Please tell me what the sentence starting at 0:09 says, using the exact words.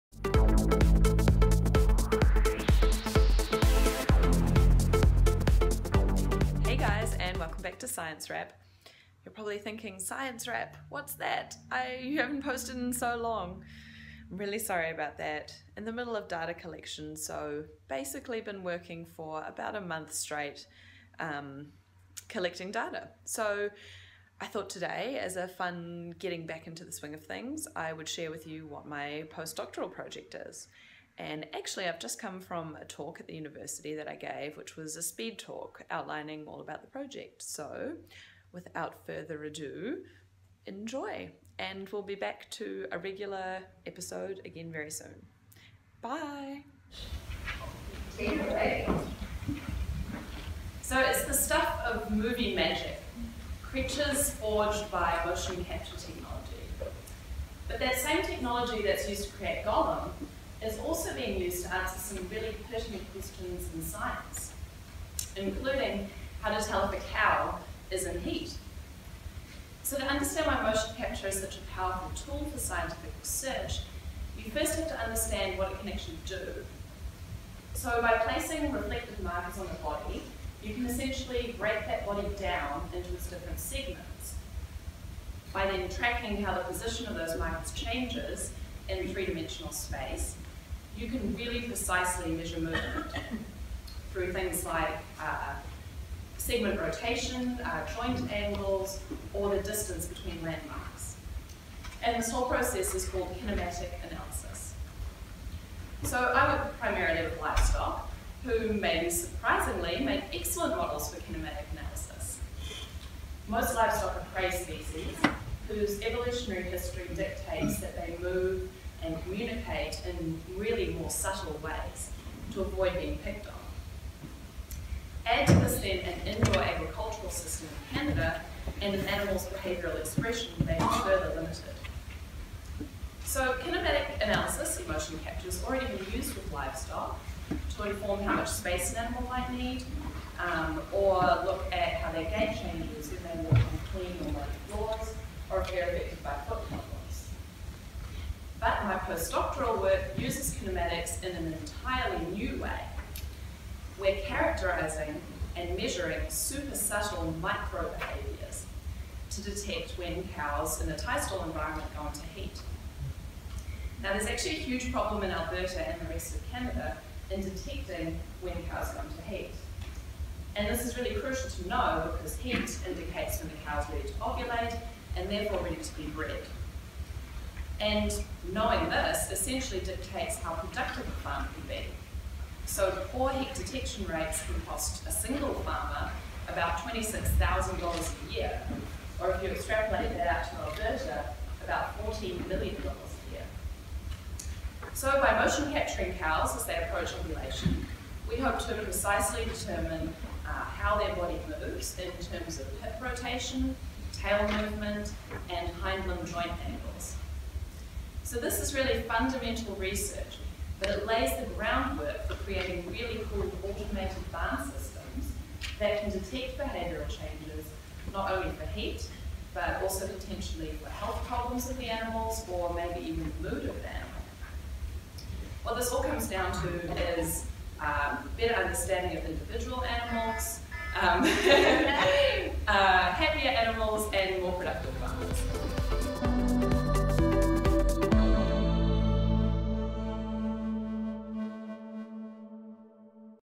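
You're probably thinking, Science Wrap, what's that?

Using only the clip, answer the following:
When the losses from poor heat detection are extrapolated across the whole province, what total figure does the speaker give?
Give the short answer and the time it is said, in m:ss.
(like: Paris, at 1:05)
$14 million, at 3:12.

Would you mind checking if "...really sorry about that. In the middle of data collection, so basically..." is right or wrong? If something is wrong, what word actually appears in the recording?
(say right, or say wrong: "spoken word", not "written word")
right.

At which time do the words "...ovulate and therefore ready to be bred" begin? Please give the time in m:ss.
2:54.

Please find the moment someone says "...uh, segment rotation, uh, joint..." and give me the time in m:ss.
1:35.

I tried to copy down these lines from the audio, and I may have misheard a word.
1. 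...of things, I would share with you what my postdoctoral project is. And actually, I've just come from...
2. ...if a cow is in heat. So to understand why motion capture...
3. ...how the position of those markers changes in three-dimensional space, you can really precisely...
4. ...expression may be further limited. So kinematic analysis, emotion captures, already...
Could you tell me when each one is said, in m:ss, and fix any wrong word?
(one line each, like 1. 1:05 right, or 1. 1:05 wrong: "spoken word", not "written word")
1. 0:27 right
2. 1:06 right
3. 1:26 right
4. 2:09 right.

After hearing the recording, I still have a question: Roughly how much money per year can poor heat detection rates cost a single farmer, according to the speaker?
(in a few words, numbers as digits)
$26,000.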